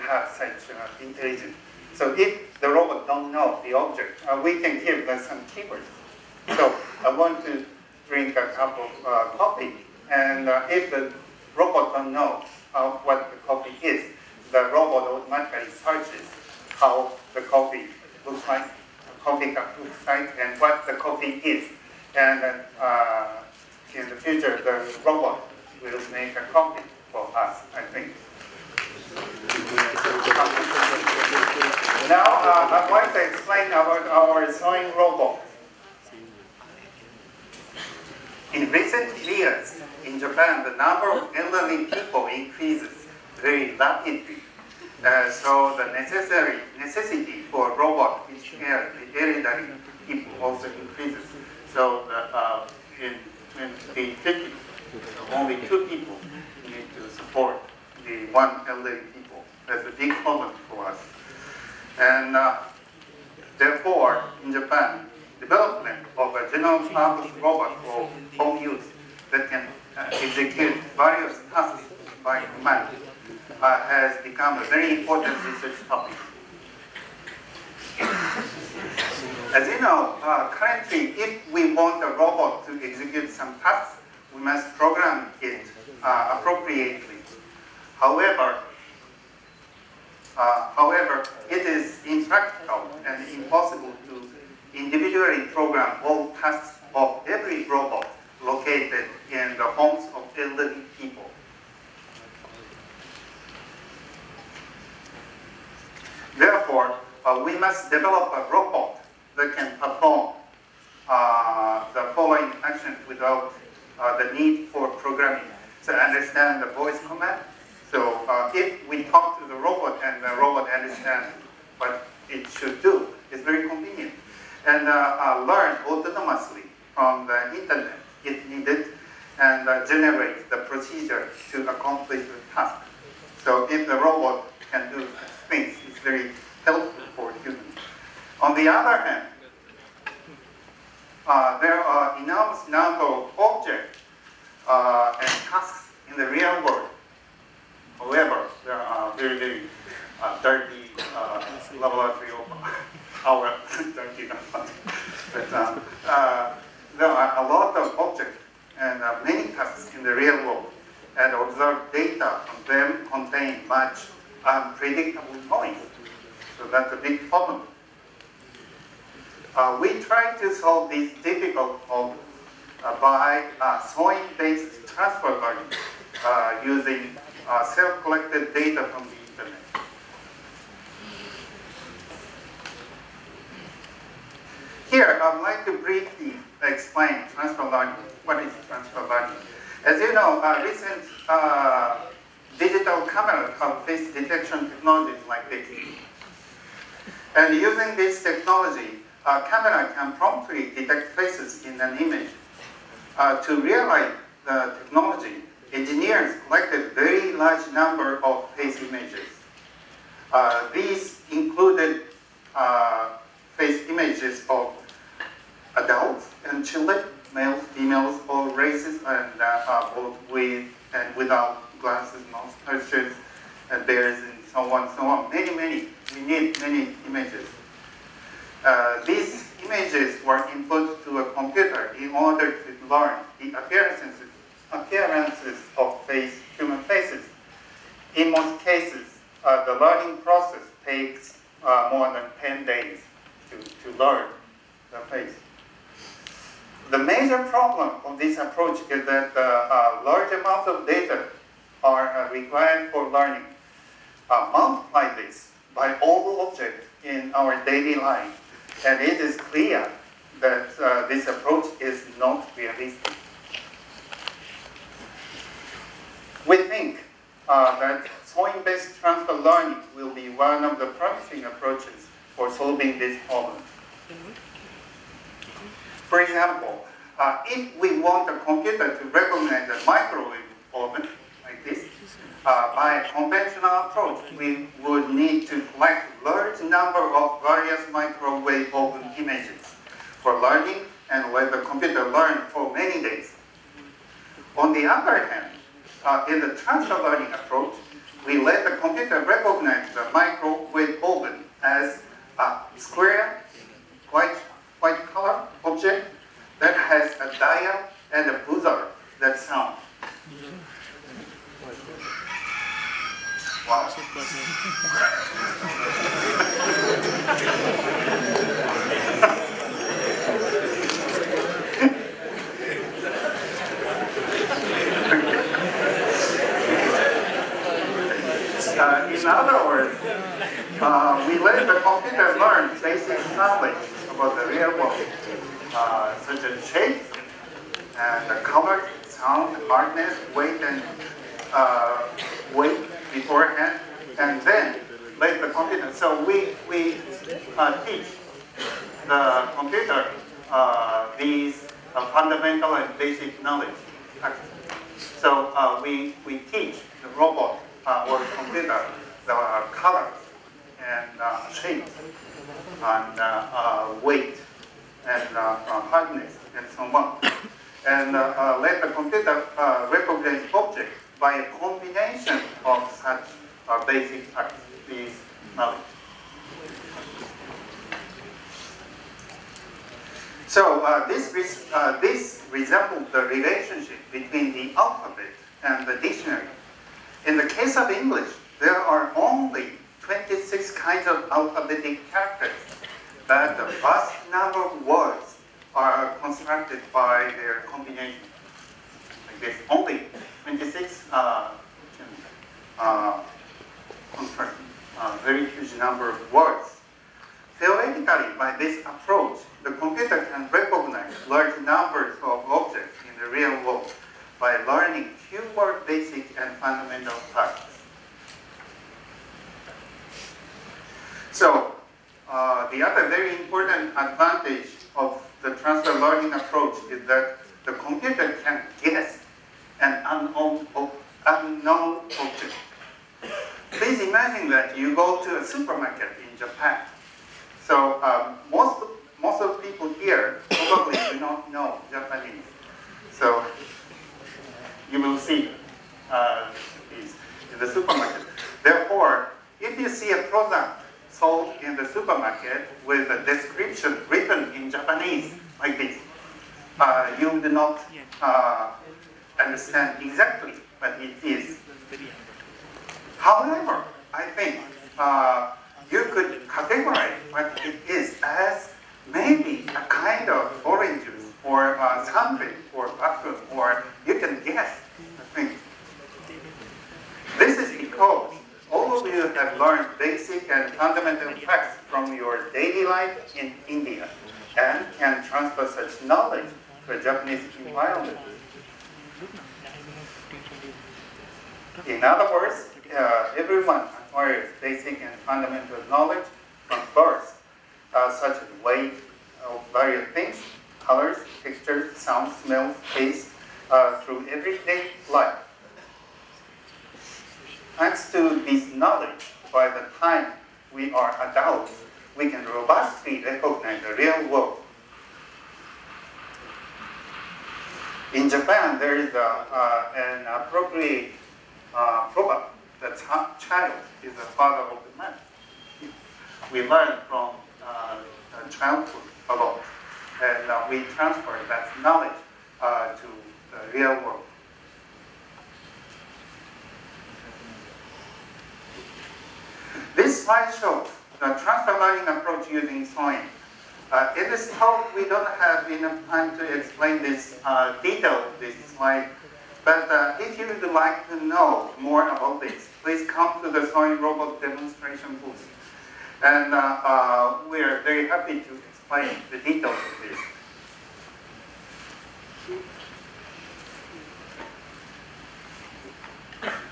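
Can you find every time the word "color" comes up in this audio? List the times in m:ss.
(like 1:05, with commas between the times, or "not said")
5:05, 5:38, 5:59, 8:20.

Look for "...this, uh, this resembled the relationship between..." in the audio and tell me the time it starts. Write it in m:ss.
6:21.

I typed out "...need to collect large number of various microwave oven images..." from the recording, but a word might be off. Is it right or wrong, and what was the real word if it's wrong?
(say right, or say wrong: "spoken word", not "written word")
right.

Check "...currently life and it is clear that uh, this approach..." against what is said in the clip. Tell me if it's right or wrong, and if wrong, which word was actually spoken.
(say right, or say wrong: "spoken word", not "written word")
wrong: "daily", not "currently".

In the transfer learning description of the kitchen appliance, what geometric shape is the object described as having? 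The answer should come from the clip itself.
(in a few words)
square.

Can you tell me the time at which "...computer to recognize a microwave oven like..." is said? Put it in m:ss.
4:38.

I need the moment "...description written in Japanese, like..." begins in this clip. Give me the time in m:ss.
7:33.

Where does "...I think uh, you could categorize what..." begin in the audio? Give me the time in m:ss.
7:44.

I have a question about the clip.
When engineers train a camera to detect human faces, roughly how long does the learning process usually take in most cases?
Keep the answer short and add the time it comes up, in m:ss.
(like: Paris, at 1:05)
more than 10 days, at 4:01.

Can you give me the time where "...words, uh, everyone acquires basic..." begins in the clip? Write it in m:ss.
8:12.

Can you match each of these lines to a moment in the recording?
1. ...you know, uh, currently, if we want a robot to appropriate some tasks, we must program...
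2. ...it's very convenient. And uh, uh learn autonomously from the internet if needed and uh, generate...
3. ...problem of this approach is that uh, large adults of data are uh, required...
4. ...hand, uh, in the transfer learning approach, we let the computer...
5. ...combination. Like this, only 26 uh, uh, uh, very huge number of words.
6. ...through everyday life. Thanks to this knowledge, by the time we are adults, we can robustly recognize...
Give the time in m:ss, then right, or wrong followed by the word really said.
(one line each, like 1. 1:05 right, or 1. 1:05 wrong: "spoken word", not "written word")
1. 1:19 wrong: "execute", not "appropriate"
2. 2:03 right
3. 4:07 wrong: "amounts", not "adults"
4. 4:55 right
5. 6:37 right
6. 8:24 right.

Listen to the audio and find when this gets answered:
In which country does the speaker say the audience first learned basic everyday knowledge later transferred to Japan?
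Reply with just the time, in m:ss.
8:03.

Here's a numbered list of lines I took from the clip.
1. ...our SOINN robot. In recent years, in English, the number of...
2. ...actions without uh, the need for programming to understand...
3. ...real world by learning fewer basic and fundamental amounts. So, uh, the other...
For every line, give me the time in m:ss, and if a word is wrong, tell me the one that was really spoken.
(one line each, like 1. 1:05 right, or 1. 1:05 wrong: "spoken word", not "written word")
1. 0:34 wrong: "Japan", not "English"
2. 1:52 right
3. 6:53 wrong: "facts", not "amounts".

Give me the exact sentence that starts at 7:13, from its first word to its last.
Please imagine that you go to a supermarket in Japan.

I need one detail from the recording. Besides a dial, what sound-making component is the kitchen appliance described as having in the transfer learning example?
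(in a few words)
a buzzer.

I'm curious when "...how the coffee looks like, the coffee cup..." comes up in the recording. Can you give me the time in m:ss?
0:16.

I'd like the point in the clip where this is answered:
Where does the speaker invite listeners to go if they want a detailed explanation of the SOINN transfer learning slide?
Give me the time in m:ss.
9:13.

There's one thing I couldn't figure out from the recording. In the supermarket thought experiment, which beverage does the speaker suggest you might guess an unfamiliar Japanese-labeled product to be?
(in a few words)
orange juice.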